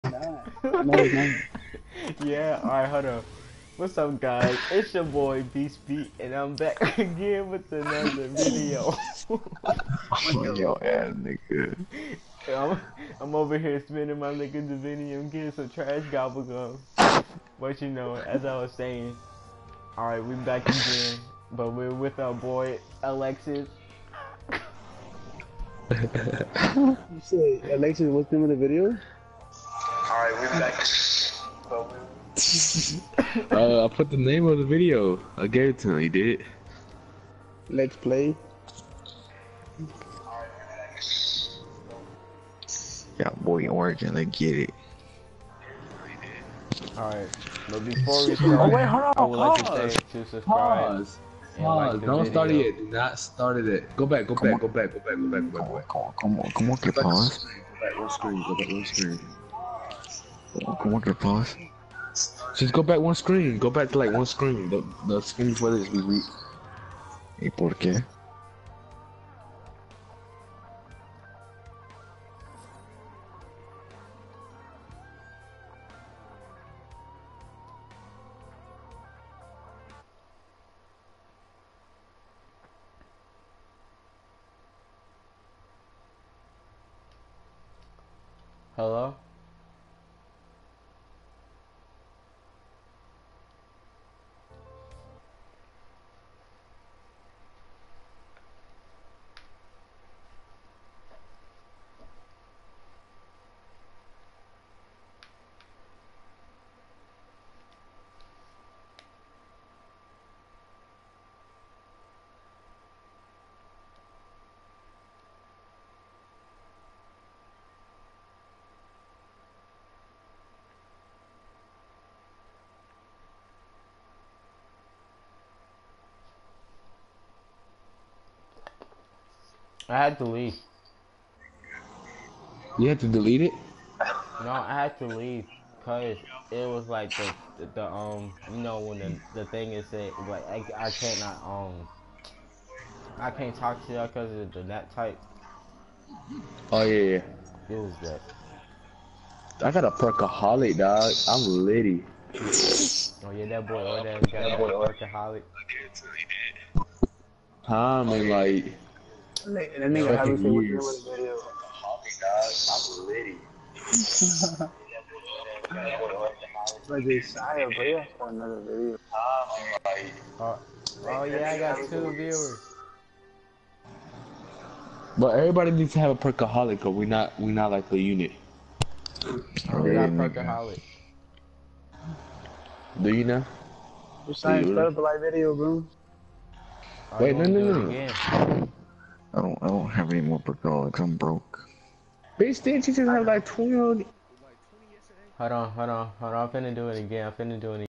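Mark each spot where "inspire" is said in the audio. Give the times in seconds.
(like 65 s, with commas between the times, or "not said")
not said.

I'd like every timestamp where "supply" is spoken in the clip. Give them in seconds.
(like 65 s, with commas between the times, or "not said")
not said.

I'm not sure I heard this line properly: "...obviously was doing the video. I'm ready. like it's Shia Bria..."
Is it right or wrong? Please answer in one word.
right.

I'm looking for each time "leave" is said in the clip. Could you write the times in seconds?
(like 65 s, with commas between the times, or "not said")
130 s, 135 s.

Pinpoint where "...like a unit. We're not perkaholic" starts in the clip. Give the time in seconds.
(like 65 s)
177 s.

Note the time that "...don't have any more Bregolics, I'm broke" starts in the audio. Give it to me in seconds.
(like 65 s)
189 s.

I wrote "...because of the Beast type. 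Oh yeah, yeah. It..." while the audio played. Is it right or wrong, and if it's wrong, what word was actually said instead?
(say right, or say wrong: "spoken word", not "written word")
wrong: "NAT", not "Beast".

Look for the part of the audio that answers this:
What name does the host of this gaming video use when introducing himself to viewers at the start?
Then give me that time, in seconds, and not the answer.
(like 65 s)
5 s.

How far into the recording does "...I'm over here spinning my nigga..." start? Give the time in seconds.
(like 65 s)
13 s.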